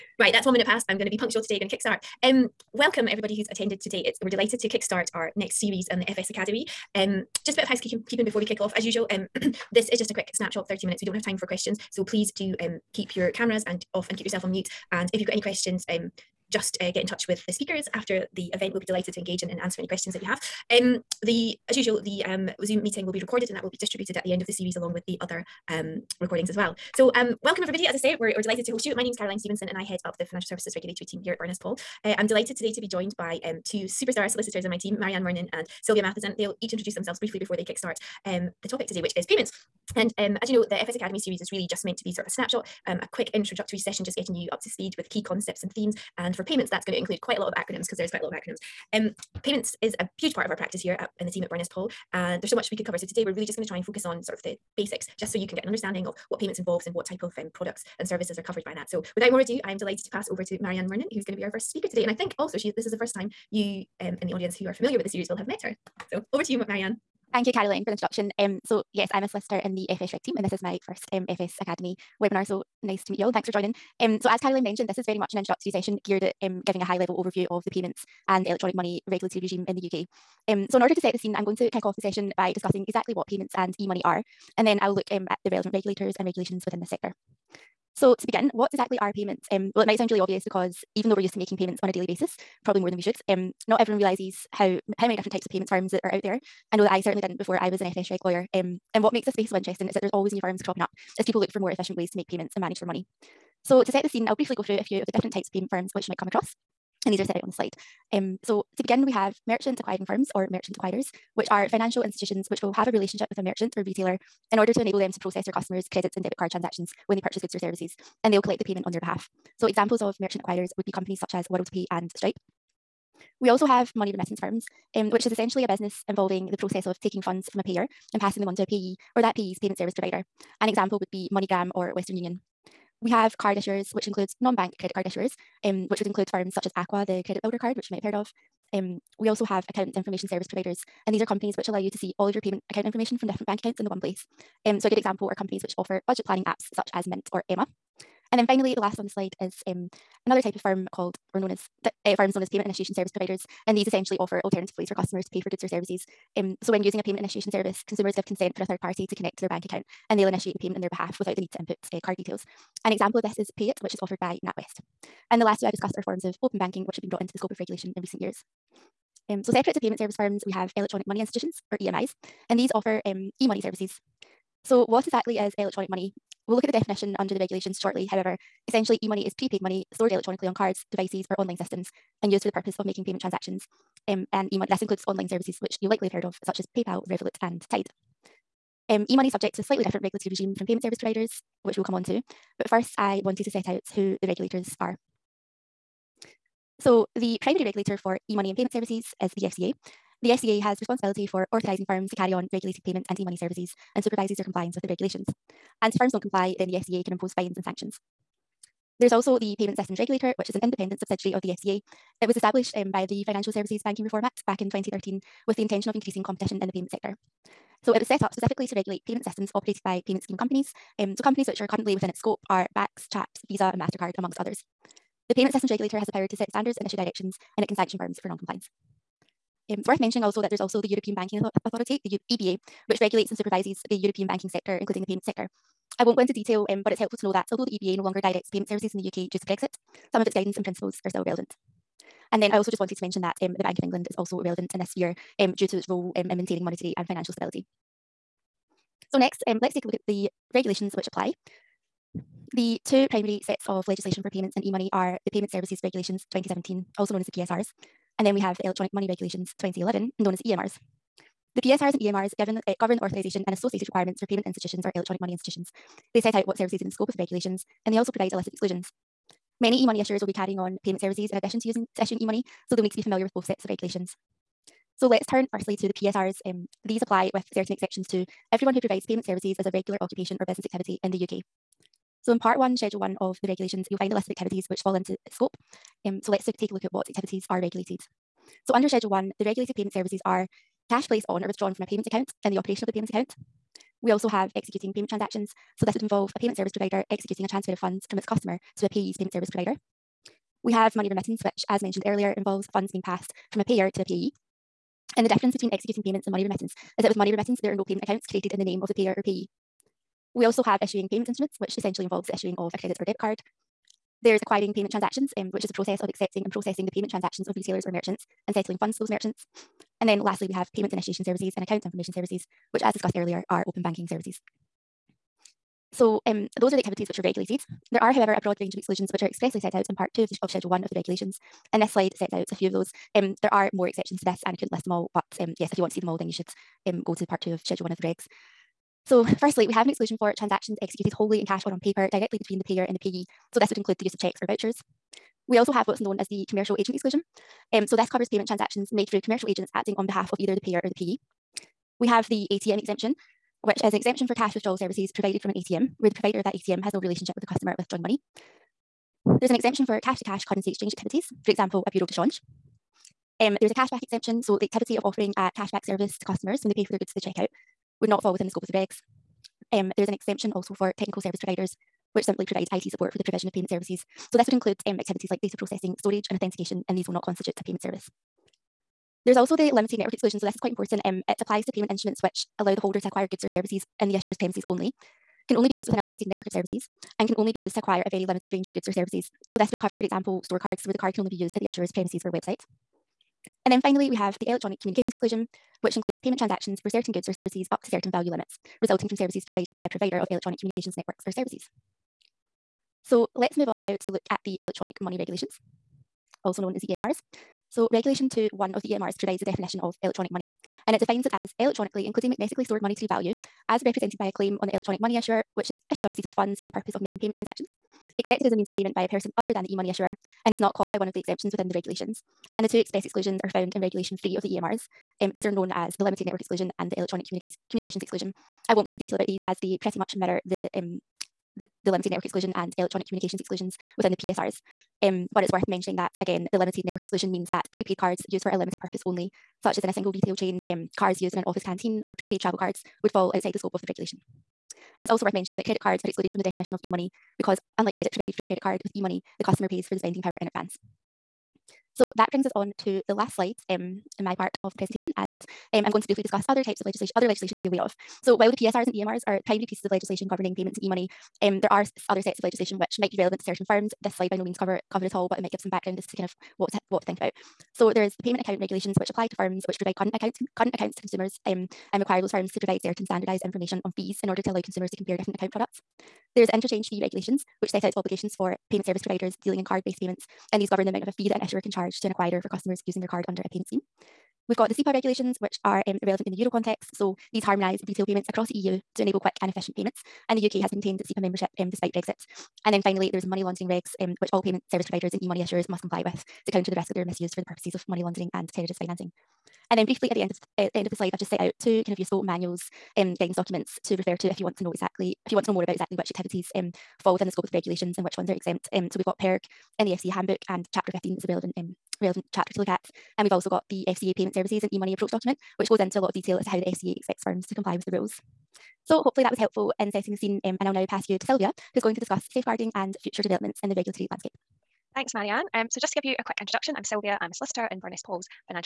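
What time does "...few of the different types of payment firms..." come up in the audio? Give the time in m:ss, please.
1:44.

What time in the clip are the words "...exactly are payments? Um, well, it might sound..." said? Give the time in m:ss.
1:28.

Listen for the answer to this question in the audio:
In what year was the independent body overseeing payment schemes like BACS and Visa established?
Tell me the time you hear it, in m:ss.
3:34.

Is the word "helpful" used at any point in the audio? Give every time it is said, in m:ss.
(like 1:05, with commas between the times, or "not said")
3:56, 8:39.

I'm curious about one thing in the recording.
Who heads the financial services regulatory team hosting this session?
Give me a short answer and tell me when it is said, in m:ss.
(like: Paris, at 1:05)
Caroline Stevenson, at 0:29.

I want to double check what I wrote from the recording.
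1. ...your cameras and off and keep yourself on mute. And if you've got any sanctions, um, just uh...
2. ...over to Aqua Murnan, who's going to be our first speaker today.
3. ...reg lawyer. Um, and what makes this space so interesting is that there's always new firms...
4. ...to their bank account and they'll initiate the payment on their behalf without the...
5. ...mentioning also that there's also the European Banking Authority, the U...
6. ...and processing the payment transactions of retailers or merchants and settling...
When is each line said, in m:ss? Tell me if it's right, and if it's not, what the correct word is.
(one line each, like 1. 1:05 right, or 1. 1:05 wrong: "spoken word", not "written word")
1. 0:13 wrong: "questions", not "sanctions"
2. 1:00 wrong: "Marianne", not "Aqua"
3. 1:38 right
4. 2:39 right
5. 3:49 right
6. 5:16 right.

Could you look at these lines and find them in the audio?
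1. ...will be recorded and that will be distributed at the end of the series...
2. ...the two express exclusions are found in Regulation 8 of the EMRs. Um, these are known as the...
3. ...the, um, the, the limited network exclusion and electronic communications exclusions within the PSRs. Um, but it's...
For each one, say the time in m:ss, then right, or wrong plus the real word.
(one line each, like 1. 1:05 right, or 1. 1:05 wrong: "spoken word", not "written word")
1. 0:23 right
2. 7:02 wrong: "3", not "8"
3. 7:10 right.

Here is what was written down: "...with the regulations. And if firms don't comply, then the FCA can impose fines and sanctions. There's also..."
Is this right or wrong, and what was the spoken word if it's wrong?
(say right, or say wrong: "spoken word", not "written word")
right.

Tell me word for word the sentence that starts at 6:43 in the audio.
So let's move on now to look at the electronic money regulations, also known as the EMRs.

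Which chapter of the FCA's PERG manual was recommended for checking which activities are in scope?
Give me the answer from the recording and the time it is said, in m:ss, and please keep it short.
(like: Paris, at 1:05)
Chapter 15, at 8:30.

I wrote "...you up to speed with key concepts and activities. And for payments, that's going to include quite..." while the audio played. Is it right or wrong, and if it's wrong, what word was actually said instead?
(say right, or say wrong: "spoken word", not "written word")
wrong: "themes", not "activities".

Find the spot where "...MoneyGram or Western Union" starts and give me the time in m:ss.
2:11.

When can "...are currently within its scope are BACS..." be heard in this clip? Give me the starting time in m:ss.
3:41.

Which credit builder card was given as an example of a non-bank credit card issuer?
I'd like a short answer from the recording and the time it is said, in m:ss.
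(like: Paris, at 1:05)
Aqua, at 2:16.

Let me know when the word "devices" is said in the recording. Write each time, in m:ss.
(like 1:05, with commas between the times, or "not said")
3:00.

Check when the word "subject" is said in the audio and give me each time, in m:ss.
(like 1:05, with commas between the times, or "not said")
3:09.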